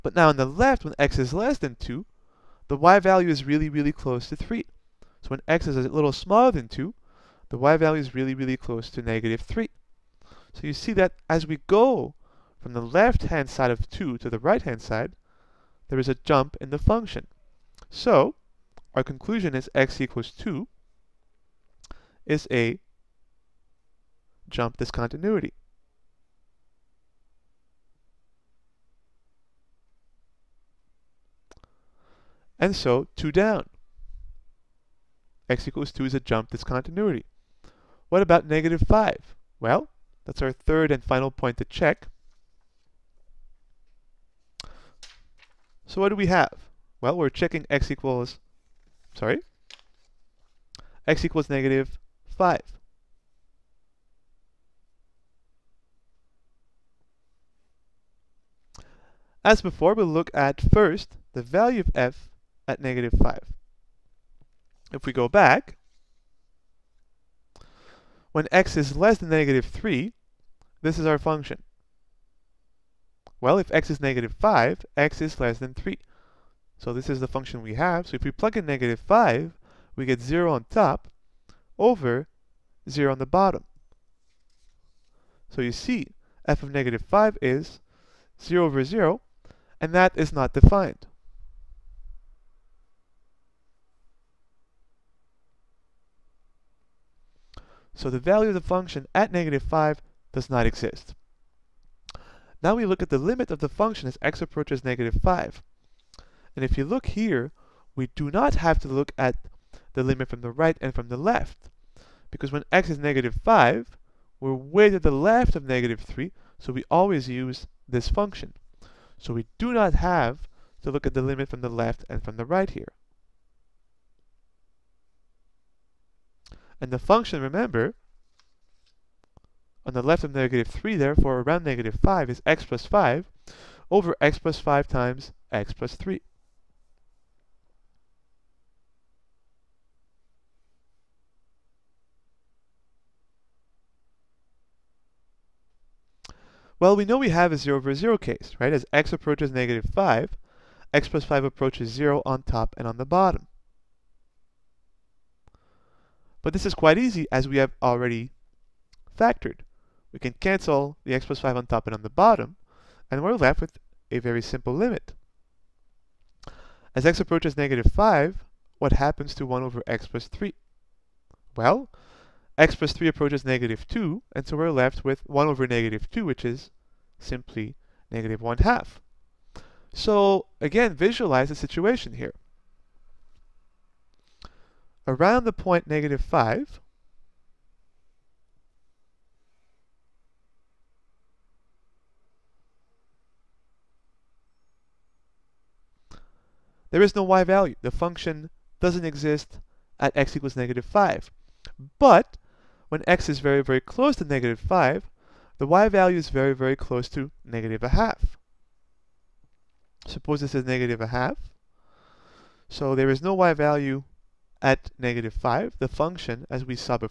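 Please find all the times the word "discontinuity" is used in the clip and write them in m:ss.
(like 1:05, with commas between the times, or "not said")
0:24, 0:36.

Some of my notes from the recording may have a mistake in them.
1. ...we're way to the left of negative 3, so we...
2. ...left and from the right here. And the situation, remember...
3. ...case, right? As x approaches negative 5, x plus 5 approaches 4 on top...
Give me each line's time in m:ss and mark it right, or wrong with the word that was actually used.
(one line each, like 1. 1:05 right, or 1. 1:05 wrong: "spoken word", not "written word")
1. 1:54 right
2. 2:01 wrong: "function", not "situation"
3. 2:28 wrong: "0", not "4".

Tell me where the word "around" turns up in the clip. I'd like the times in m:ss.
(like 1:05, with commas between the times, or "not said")
2:11, 3:05.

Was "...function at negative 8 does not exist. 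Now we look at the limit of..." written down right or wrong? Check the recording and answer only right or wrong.
wrong.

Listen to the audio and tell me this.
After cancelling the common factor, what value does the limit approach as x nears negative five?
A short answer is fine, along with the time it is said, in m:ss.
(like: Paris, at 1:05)
-1/2, at 2:58.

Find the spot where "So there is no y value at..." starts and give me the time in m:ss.
3:32.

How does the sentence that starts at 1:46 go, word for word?
And if you look here, we do not have to look at the limit from the right and from the left.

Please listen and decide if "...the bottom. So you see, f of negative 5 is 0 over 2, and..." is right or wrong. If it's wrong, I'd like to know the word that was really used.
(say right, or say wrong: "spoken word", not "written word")
wrong: "0", not "2".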